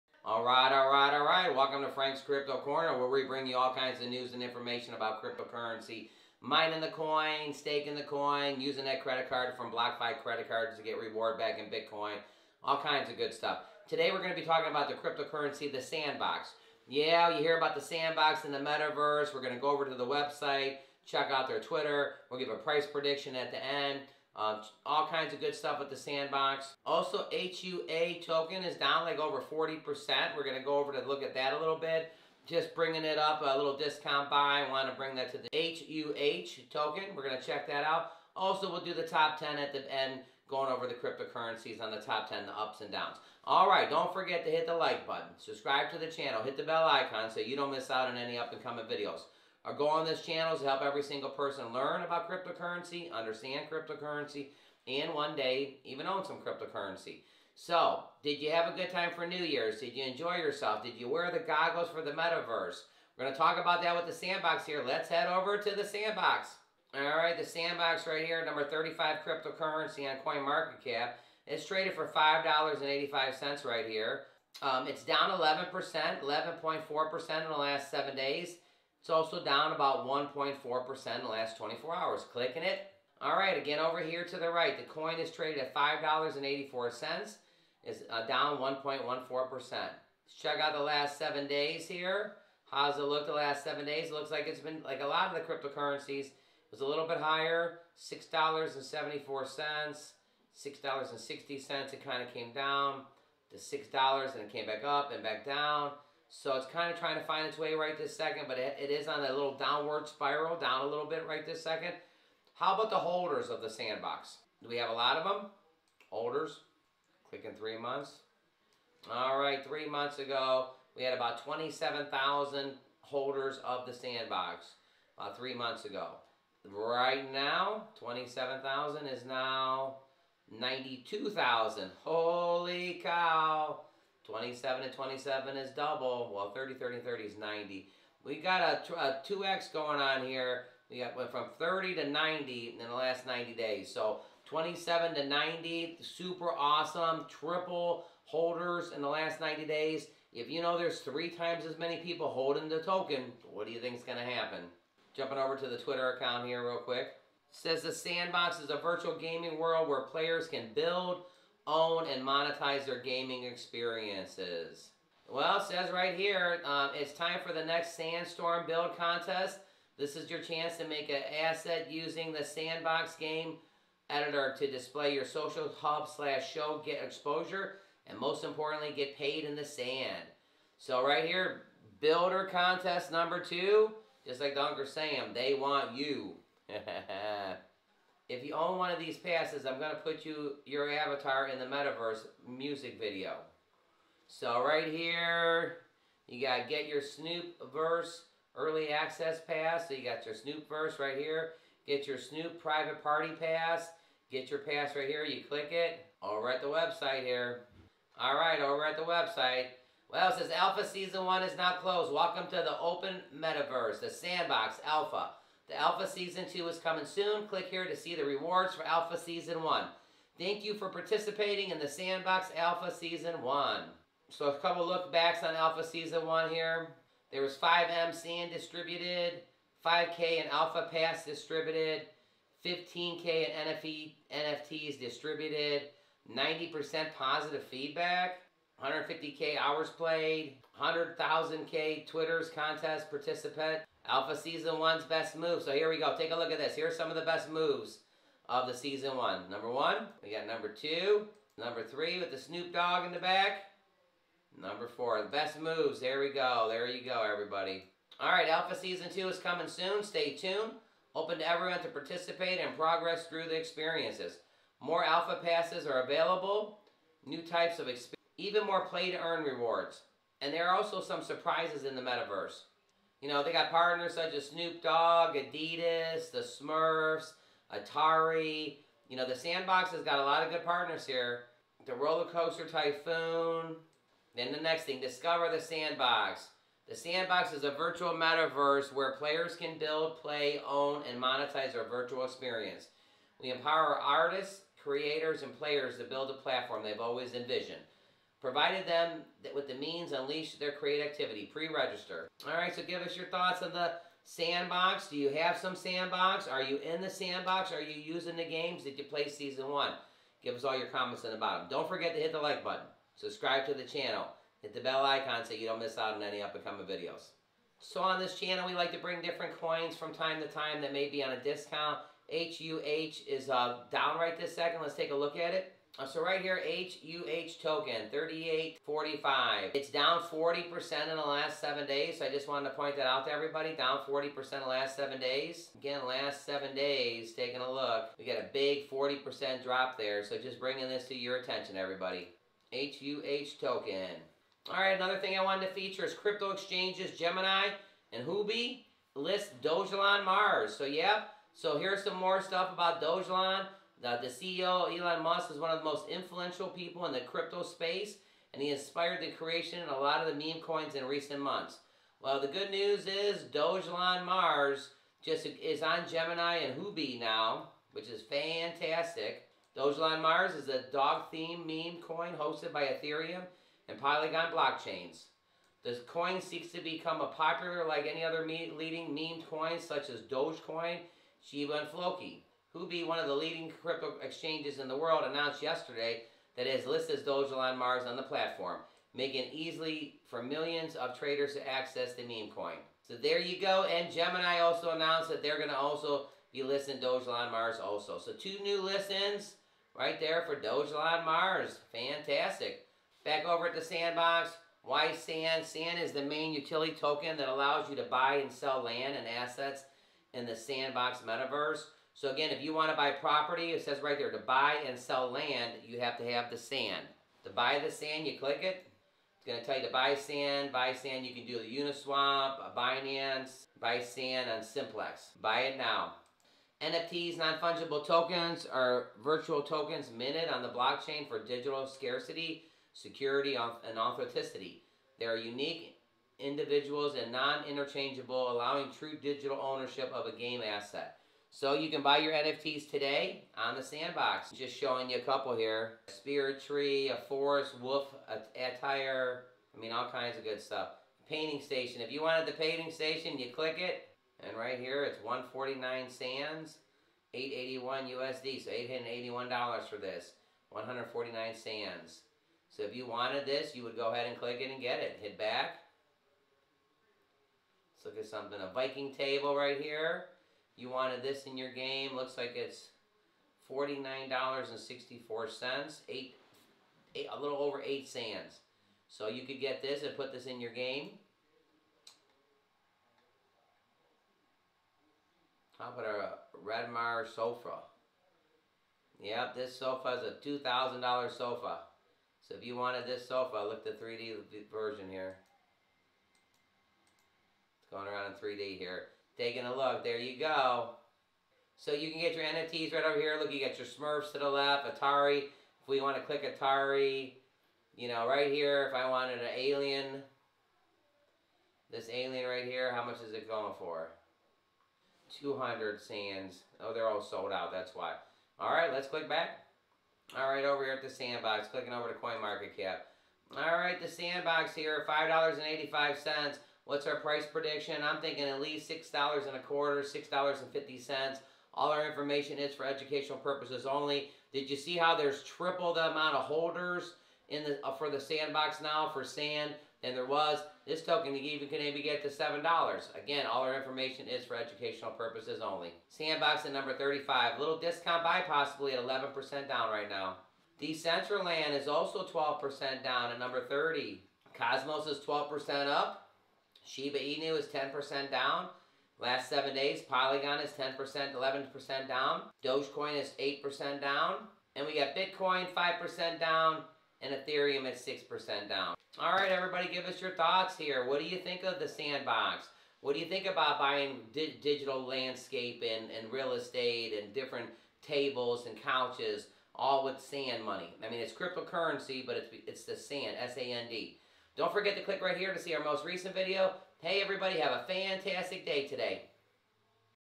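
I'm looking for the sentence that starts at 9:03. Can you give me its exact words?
Again, all our information is for educational purposes only.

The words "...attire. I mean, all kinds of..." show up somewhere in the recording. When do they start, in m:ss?
7:28.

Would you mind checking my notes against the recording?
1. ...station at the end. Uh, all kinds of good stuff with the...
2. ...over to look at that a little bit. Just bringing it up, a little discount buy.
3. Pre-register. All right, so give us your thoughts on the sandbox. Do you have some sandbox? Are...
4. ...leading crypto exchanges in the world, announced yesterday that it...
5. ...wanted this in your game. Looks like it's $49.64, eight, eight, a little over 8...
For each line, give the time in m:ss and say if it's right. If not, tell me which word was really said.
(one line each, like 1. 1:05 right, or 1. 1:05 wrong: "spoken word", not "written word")
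1. 0:22 wrong: "prediction", not "station"
2. 0:30 right
3. 5:01 right
4. 6:23 right
5. 7:50 right.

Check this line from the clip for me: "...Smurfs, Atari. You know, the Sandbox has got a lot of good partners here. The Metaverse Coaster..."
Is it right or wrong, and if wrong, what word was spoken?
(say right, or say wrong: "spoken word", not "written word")
wrong: "Roller", not "Metaverse".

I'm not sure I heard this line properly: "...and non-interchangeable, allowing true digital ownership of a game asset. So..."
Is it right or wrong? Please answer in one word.
right.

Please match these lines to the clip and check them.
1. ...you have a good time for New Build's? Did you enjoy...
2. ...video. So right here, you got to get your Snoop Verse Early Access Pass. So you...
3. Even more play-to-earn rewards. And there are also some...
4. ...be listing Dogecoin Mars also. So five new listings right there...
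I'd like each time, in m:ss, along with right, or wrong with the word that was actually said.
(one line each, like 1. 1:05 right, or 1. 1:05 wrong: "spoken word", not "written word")
1. 0:58 wrong: "Year", not "Build"
2. 3:12 right
3. 4:28 right
4. 6:36 wrong: "two", not "five".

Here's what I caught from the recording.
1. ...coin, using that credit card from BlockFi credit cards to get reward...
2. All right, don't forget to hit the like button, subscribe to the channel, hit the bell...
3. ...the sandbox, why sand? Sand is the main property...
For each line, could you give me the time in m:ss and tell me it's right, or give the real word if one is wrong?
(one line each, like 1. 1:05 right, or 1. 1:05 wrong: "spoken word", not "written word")
1. 0:08 right
2. 0:43 right
3. 6:43 wrong: "utility", not "property".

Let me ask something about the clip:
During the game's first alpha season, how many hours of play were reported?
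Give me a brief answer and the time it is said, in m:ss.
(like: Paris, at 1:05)
150K, at 3:58.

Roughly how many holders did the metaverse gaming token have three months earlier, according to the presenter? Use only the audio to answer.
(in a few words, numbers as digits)
27,000.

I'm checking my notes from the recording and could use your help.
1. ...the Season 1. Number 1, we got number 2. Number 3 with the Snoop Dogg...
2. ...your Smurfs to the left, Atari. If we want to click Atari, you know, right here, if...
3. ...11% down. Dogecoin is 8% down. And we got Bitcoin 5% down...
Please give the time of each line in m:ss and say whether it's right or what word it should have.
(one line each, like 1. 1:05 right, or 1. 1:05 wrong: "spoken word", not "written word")
1. 4:08 right
2. 8:23 right
3. 9:21 right.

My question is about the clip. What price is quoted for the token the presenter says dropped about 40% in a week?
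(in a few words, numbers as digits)
38.45.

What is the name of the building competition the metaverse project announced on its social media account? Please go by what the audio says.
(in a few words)
Sandstorm Build Contest.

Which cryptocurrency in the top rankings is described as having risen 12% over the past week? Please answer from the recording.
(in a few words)
Cosmos.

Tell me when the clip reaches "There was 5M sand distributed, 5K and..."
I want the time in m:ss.
3:47.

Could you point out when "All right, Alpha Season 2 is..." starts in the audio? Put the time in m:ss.
4:18.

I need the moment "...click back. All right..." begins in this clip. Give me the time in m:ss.
8:39.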